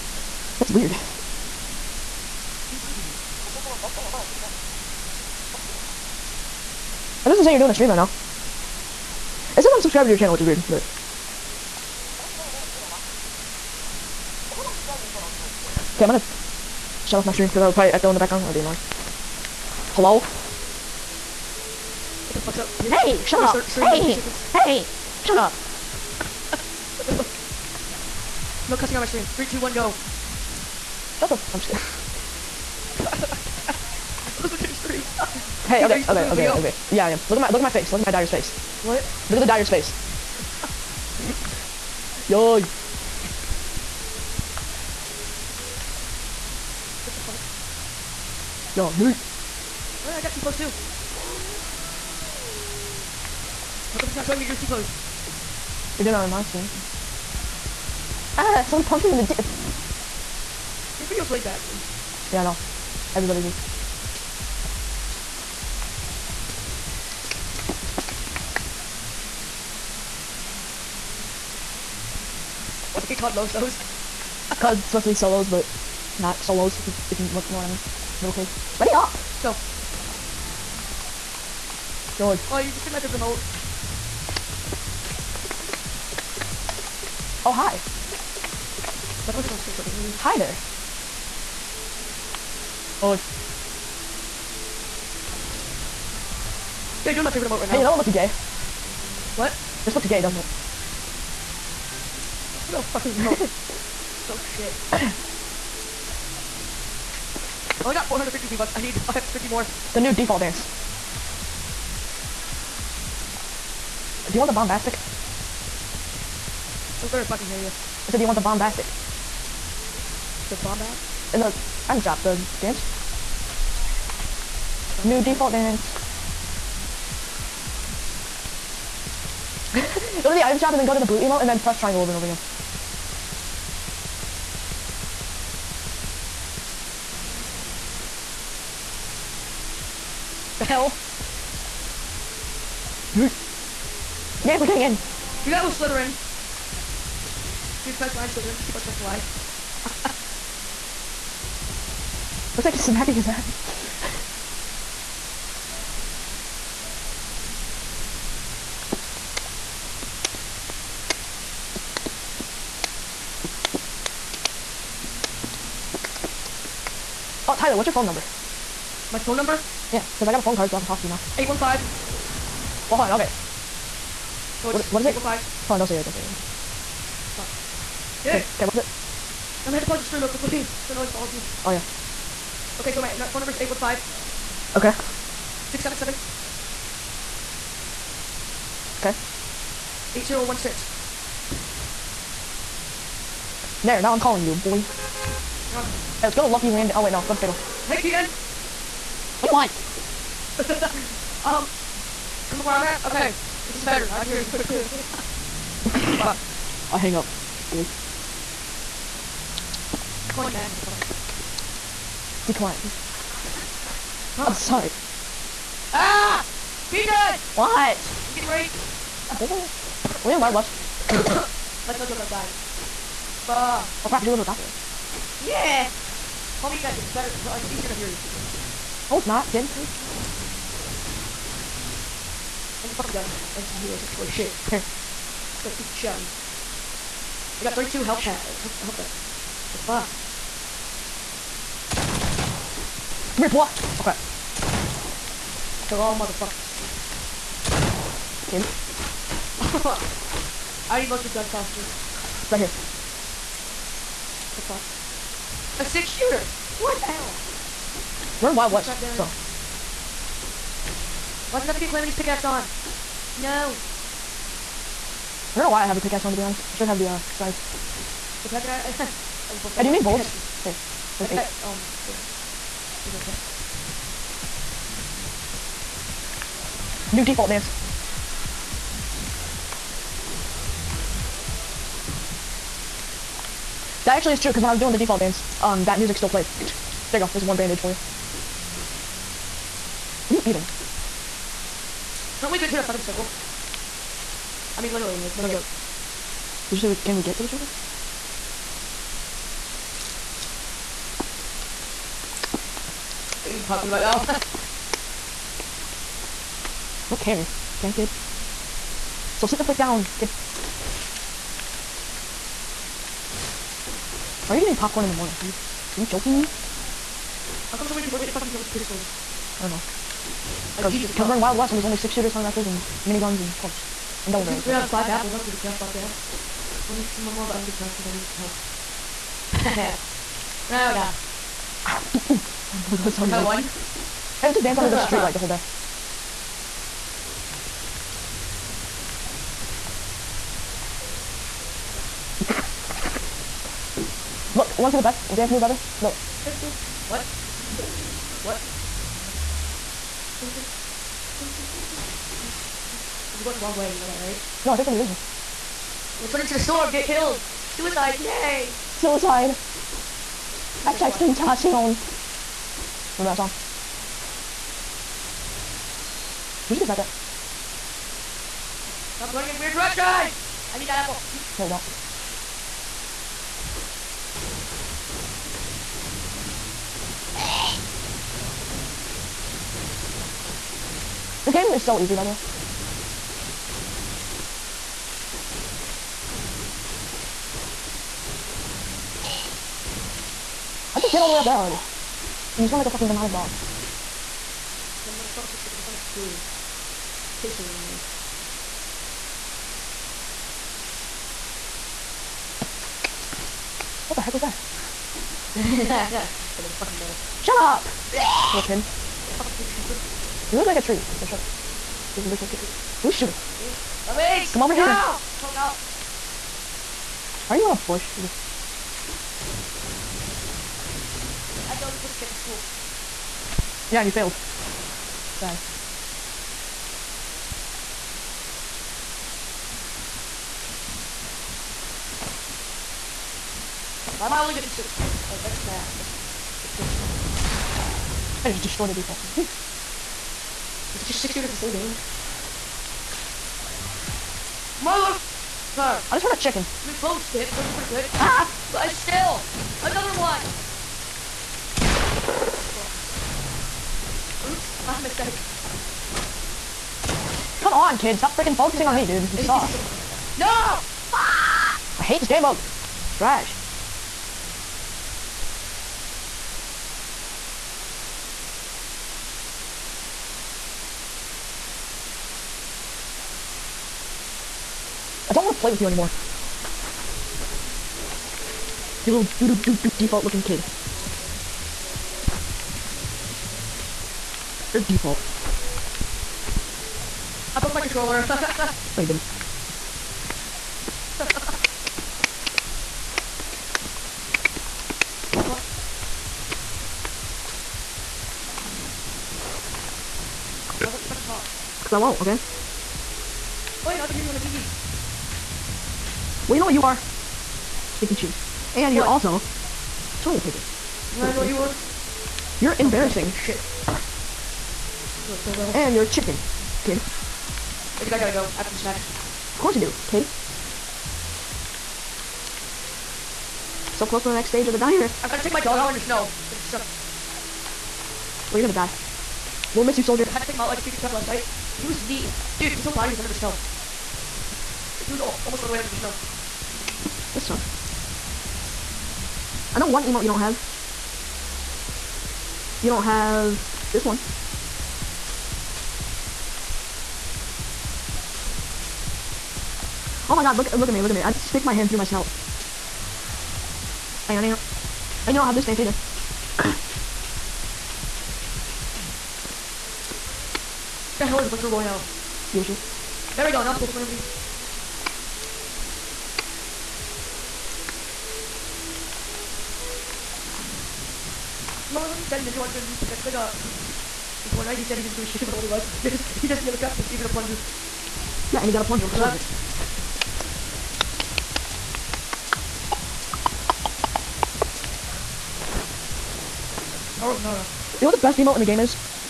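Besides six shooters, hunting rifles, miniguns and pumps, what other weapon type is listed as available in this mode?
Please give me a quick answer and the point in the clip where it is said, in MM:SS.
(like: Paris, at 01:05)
Double barrels, at 05:24.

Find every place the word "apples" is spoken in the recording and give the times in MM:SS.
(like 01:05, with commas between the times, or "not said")
05:25, 06:11.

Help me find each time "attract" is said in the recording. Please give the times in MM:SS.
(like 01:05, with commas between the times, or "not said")
not said.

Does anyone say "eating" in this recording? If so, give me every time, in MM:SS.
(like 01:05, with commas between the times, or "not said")
04:50, 05:14.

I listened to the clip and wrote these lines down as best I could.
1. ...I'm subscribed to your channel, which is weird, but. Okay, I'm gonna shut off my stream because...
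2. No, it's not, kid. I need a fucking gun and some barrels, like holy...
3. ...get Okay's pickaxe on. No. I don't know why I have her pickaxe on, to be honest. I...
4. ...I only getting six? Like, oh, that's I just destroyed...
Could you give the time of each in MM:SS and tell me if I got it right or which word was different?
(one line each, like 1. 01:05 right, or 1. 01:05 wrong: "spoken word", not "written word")
1. 00:09 right
2. 03:49 wrong: "heals", not "barrels"
3. 04:21 wrong: "Calamity", not "Okay"
4. 07:14 right.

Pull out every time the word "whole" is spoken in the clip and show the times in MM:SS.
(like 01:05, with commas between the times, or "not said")
05:35, 07:21, 08:52.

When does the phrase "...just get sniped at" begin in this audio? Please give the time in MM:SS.
06:06.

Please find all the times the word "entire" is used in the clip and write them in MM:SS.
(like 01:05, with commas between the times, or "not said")
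not said.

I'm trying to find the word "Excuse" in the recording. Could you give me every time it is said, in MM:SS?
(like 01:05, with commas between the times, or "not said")
09:22.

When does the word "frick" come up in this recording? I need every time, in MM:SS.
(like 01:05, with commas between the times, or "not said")
05:09.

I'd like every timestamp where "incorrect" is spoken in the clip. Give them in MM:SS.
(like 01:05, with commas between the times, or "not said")
not said.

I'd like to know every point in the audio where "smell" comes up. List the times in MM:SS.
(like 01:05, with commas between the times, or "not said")
06:32.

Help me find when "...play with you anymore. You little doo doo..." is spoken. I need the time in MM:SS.
07:55.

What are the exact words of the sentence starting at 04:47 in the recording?
There you go, there's one bandage for you.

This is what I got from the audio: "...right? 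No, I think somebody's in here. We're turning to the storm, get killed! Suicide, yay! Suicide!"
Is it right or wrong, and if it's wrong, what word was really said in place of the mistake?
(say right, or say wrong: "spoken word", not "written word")
right.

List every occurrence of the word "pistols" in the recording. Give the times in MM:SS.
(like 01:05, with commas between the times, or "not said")
05:18, 06:37.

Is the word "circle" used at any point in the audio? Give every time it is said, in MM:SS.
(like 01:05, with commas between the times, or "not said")
04:53, 04:57.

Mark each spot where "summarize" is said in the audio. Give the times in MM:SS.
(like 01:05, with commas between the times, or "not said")
not said.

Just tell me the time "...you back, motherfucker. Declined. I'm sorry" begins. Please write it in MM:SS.
03:30.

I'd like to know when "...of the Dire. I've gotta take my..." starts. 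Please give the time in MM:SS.
08:44.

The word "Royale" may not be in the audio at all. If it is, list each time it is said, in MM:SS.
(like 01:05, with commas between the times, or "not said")
09:21.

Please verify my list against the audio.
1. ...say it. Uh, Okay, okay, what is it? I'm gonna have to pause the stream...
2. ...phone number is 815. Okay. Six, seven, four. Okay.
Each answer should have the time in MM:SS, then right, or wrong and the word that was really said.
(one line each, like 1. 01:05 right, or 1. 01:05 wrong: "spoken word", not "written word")
1. 02:56 right
2. 03:03 wrong: "seven", not "four".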